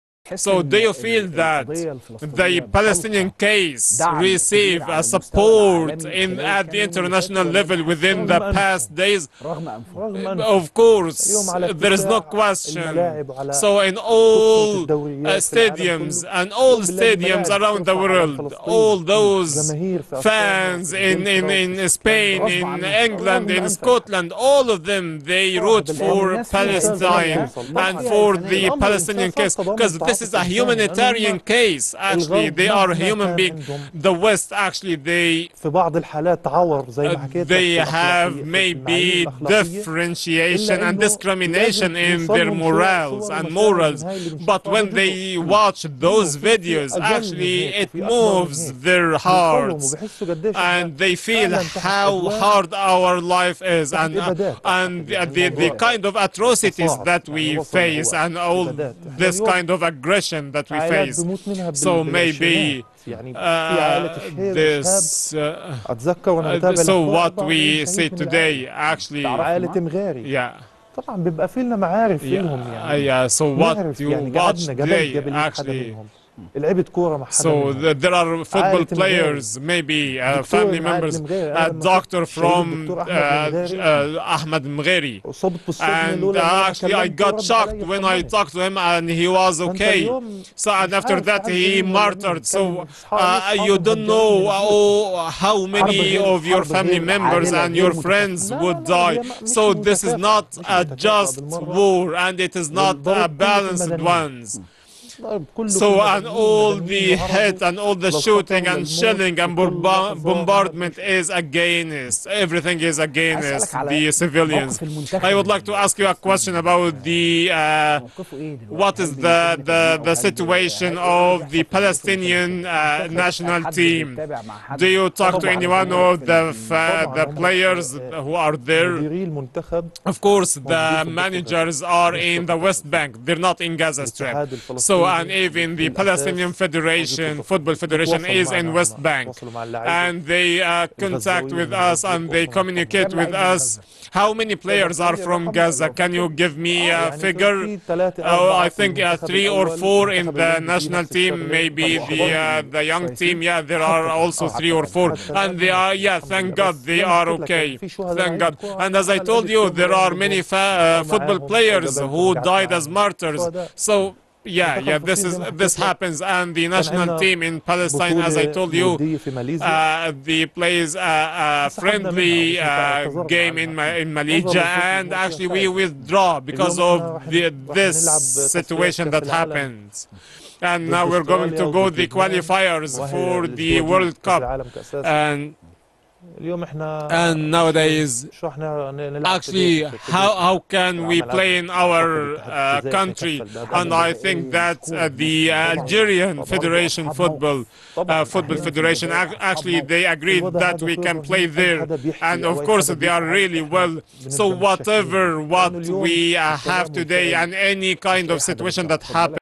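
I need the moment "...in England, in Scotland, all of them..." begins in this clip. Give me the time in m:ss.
0:22.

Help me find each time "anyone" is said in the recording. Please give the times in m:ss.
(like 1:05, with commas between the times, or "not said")
2:05.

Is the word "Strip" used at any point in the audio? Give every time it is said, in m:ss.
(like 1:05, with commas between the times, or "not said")
2:14.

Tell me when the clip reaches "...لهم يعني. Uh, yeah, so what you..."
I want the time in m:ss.
1:12.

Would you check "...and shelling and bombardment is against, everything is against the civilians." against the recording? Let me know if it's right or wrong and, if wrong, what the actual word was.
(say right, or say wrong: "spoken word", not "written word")
right.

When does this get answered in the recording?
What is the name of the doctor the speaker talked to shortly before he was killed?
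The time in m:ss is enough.
1:24.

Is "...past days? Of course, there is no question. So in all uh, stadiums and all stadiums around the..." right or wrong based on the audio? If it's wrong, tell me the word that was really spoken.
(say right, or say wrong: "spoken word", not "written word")
right.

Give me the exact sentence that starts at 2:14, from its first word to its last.
So and even the Palestinian Federation, Football Federation is in West Bank.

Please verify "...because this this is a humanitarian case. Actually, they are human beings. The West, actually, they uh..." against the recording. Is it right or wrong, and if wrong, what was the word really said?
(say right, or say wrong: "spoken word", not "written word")
right.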